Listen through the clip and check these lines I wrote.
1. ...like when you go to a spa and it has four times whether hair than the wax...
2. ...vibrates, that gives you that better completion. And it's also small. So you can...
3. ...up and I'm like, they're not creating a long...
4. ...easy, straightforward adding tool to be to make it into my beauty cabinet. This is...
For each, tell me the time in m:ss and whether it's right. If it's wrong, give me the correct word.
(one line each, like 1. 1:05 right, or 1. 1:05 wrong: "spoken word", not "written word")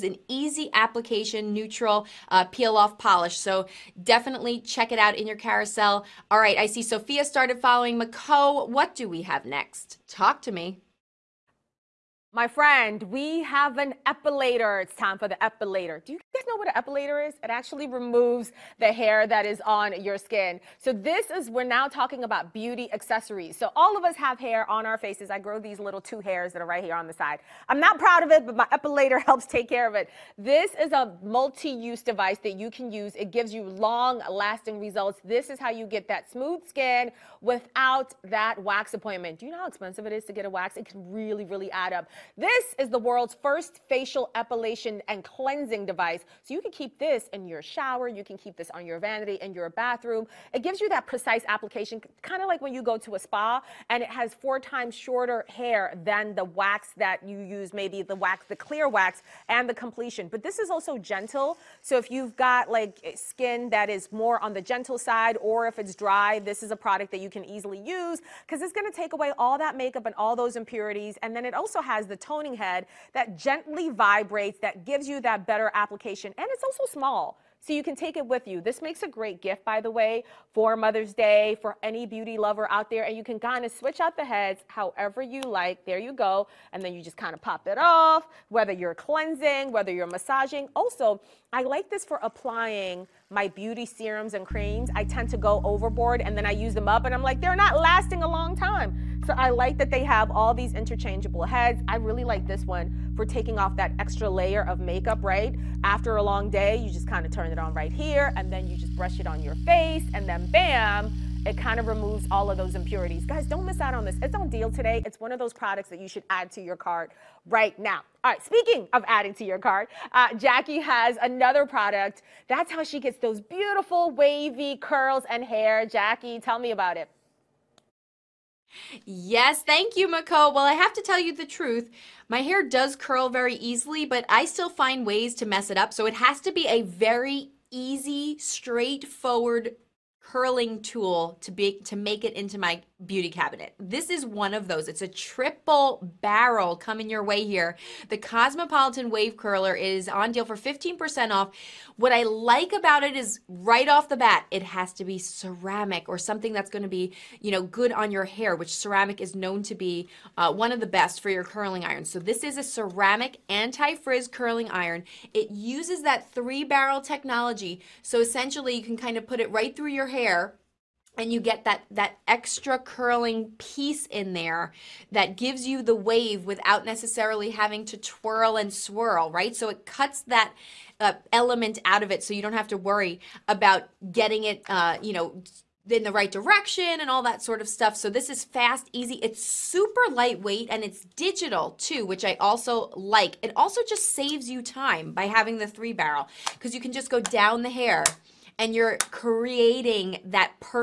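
1. 0:52 wrong: "shorter", not "whether"
2. 1:13 wrong: "application", not "completion"
3. 1:36 wrong: "lasting", not "creating"
4. 2:17 wrong: "hurling", not "adding".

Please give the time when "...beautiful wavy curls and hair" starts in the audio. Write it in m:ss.
2:03.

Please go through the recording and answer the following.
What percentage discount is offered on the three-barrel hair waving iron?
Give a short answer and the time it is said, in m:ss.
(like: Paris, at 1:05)
15%, at 2:30.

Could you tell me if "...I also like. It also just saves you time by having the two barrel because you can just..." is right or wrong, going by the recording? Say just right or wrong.
wrong.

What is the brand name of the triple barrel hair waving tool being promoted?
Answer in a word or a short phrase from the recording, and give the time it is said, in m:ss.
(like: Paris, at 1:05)
Cosmopolitan, at 2:28.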